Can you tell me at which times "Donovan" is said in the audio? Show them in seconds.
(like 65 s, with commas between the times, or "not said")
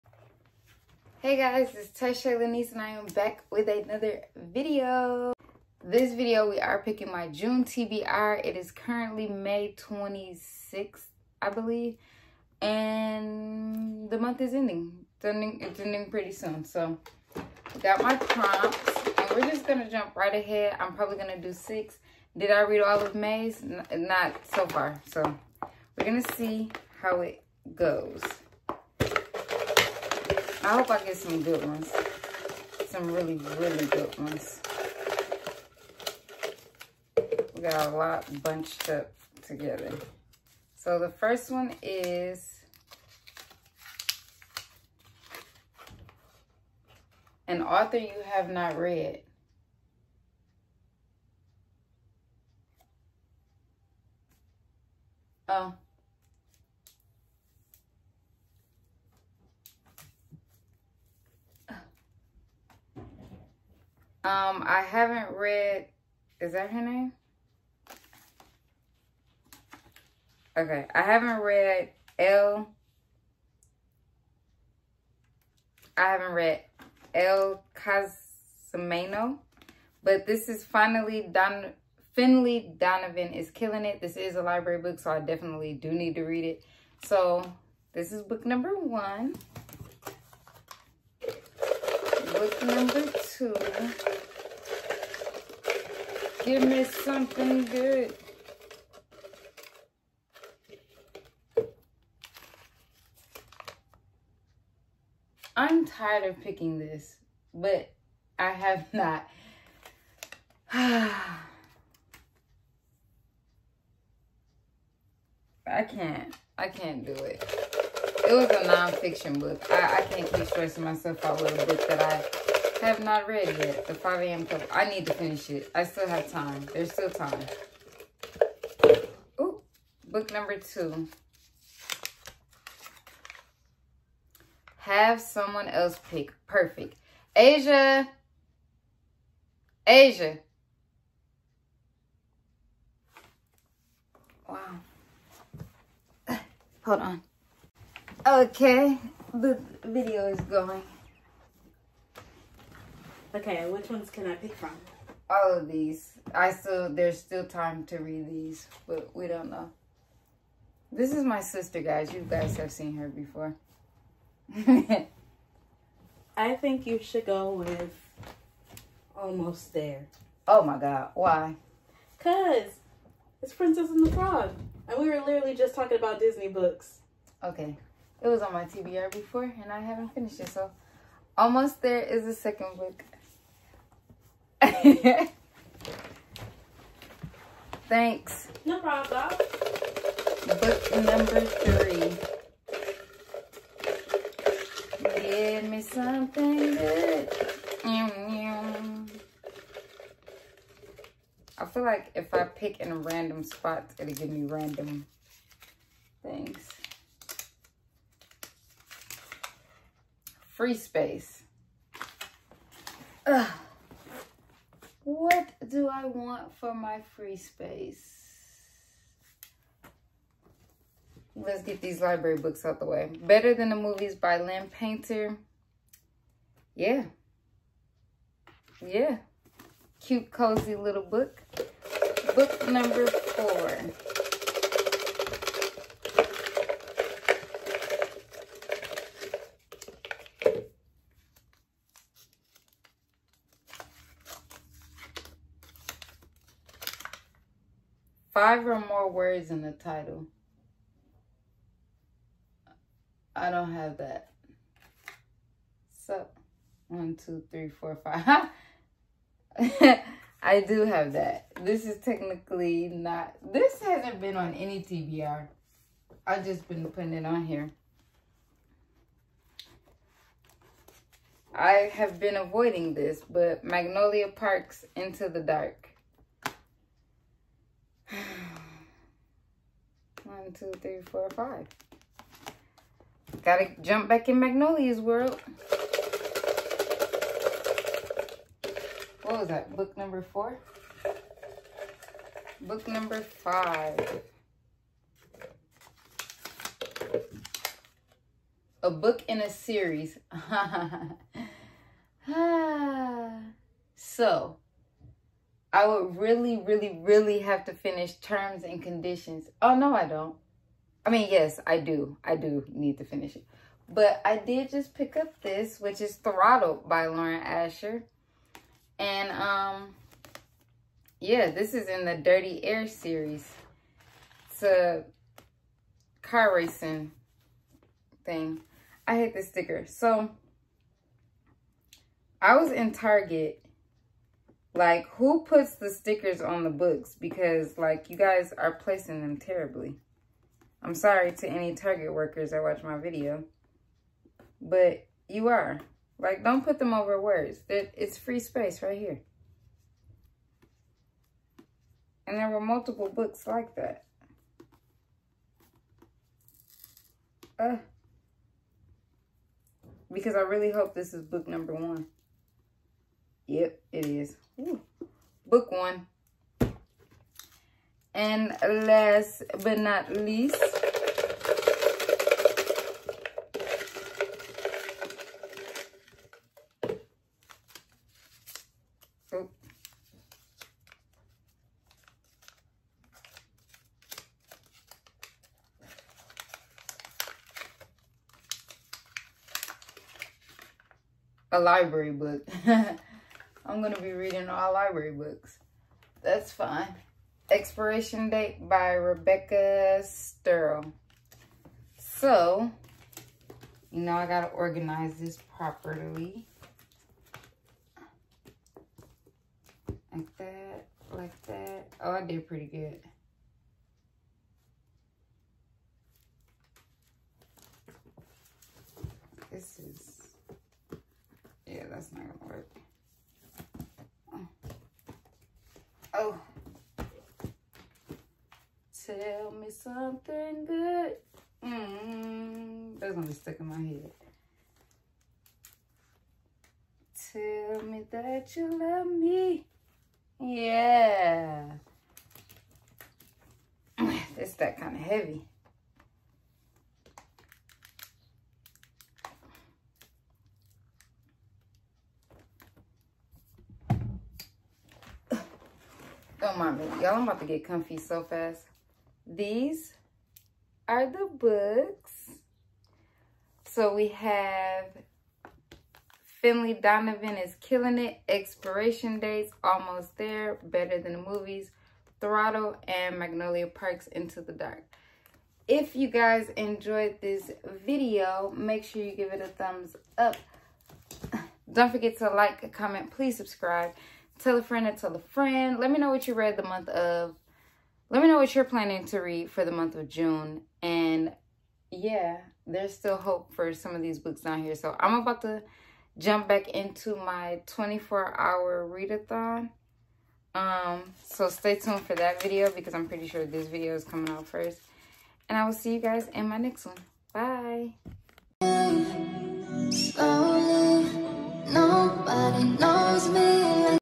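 82 s, 466 s.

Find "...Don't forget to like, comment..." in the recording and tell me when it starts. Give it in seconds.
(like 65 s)
481 s.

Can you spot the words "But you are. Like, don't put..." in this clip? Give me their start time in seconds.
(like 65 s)
344 s.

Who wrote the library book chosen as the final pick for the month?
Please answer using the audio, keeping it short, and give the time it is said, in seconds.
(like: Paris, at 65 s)
Rebecca Serle, at 398 s.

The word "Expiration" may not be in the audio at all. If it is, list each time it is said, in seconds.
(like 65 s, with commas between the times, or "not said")
397 s, 468 s.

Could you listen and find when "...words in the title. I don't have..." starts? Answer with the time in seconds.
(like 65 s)
249 s.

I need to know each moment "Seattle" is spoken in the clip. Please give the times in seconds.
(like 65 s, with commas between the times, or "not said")
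not said.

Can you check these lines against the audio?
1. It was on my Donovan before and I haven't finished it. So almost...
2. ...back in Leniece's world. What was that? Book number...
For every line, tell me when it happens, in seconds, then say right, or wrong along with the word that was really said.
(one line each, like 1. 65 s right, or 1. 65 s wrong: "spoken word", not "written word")
1. 178 s wrong: "TBR", not "Donovan"
2. 284 s wrong: "Magnolia", not "Leniece".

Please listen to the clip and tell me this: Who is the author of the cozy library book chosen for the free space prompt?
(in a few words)
Lynn Painter.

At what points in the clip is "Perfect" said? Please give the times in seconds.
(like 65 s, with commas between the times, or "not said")
136 s.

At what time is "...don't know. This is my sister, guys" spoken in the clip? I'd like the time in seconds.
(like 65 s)
159 s.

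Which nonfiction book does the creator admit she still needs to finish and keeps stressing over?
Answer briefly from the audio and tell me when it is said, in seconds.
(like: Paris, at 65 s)
The 5 a.m. Club, at 123 s.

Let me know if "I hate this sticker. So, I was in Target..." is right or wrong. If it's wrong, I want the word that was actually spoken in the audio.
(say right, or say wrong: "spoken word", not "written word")
right.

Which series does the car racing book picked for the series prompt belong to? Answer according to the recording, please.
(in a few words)
Dirty Air.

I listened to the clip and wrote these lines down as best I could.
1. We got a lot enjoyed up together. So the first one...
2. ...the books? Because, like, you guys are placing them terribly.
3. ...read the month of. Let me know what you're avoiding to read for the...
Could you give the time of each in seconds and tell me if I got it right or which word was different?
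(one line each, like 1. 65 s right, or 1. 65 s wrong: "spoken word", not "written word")
1. 37 s wrong: "bunched", not "enjoyed"
2. 336 s right
3. 486 s wrong: "planning", not "avoiding".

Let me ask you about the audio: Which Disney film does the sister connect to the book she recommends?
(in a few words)
Princess and the Frog.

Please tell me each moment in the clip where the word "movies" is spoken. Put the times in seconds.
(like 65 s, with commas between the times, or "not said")
223 s, 471 s.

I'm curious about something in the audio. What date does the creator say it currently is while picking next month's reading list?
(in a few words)
May 26th.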